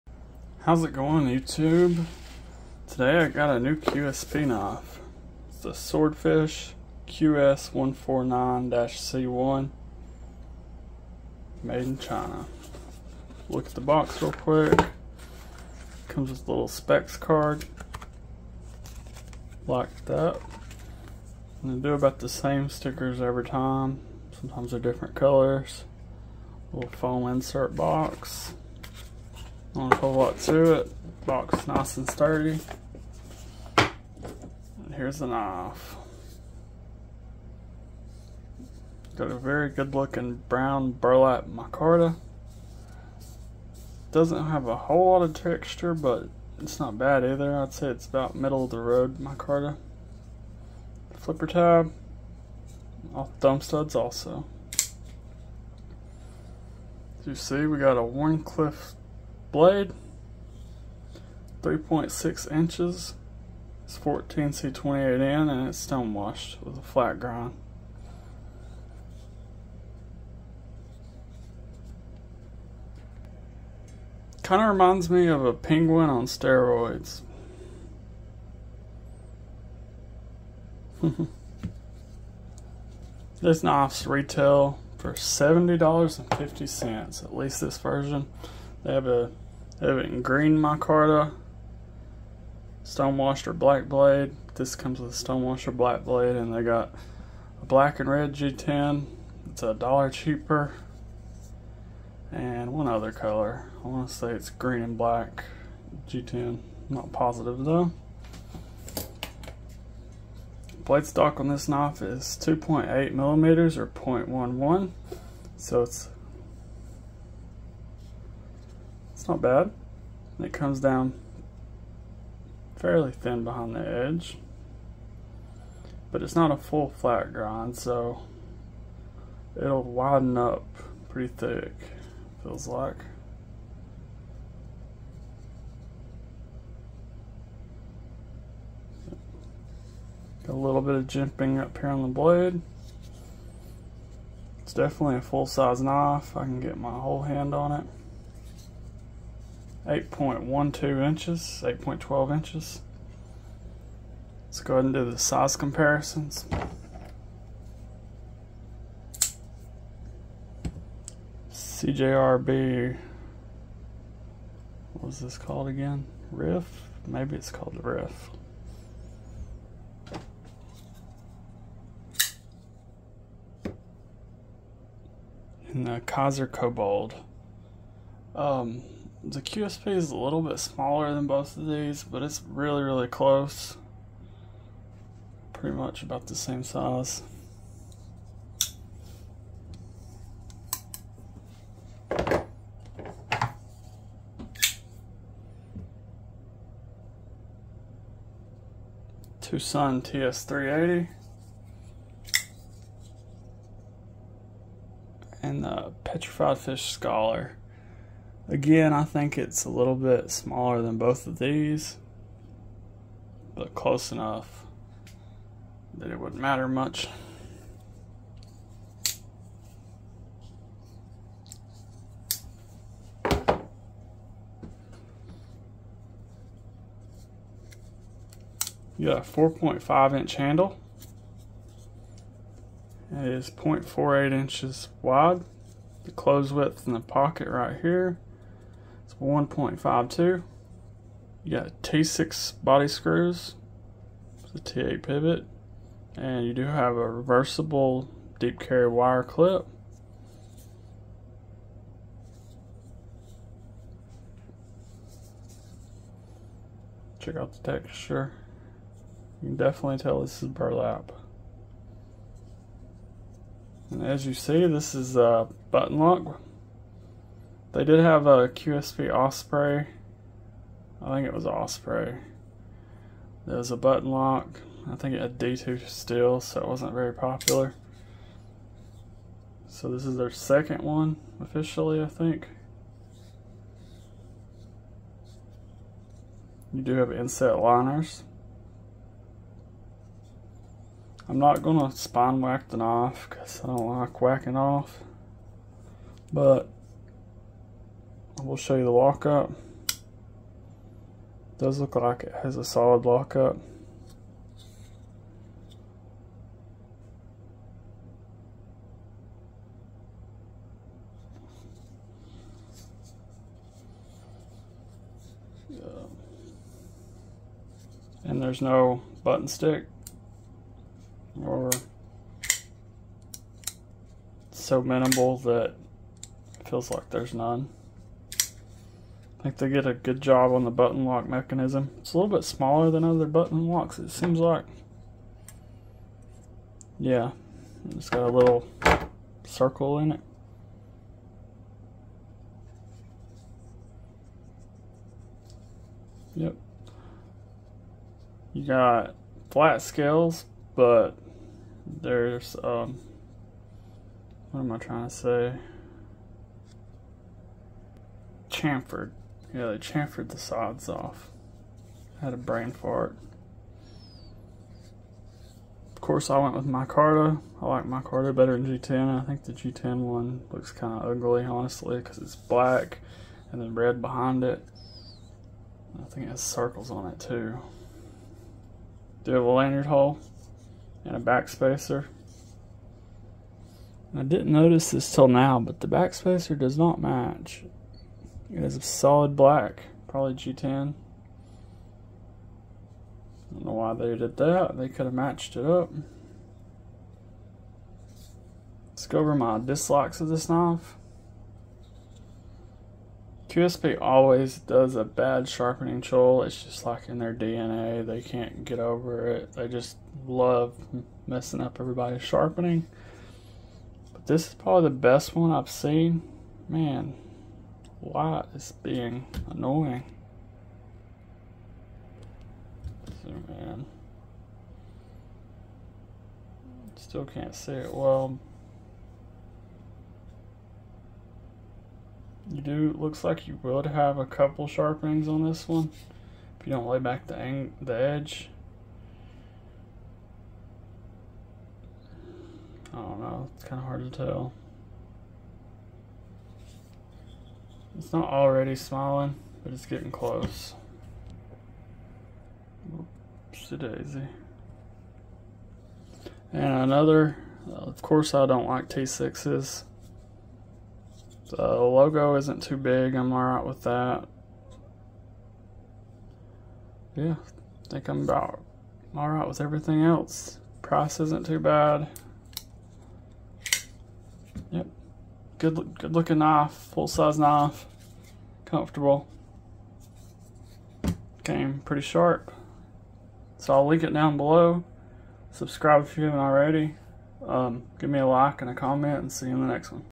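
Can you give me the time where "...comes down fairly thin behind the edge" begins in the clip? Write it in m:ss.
2:00.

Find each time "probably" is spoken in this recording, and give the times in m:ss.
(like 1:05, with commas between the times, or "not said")
6:30, 6:54.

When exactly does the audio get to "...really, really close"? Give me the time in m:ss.
3:02.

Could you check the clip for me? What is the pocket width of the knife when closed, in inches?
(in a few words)
1.52.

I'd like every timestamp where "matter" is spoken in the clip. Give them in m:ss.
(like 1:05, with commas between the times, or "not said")
3:36.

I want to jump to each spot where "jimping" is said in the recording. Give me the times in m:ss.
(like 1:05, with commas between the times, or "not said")
2:21.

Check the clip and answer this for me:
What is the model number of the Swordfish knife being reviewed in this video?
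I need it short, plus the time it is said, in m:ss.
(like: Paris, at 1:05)
QS149-C1, at 0:07.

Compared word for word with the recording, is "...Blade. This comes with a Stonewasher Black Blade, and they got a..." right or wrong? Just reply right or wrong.
right.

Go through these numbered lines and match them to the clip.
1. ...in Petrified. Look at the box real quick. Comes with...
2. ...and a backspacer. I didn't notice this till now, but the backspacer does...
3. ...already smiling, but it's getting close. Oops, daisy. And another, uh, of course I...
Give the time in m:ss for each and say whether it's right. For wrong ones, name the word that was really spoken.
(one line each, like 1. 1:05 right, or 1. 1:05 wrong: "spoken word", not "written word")
1. 0:11 wrong: "China", not "Petrified"
2. 6:21 right
3. 7:28 right.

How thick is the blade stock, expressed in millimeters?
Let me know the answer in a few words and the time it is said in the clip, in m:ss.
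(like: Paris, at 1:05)
2.8 millimeters, at 1:52.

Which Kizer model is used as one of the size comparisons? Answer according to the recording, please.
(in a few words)
Kobold.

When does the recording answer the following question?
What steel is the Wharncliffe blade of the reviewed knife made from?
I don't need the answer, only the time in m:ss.
1:03.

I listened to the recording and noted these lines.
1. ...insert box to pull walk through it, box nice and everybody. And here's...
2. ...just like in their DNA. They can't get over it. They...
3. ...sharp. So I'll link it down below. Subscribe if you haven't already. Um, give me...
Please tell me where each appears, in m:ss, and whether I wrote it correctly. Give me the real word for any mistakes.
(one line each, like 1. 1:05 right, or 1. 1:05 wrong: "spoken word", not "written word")
1. 0:27 wrong: "sturdy", not "everybody"
2. 6:46 right
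3. 8:02 right.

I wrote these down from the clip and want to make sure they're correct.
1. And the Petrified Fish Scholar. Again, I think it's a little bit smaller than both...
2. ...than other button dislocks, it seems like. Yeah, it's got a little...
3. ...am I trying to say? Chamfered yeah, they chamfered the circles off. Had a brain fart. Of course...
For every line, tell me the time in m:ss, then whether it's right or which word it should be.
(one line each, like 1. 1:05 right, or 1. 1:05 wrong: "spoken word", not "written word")
1. 3:25 right
2. 5:32 wrong: "locks", not "dislocks"
3. 5:54 wrong: "sides", not "circles".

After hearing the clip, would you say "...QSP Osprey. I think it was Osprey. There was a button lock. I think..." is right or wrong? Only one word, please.
right.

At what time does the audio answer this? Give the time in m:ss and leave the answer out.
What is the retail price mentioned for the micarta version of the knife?
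1:25.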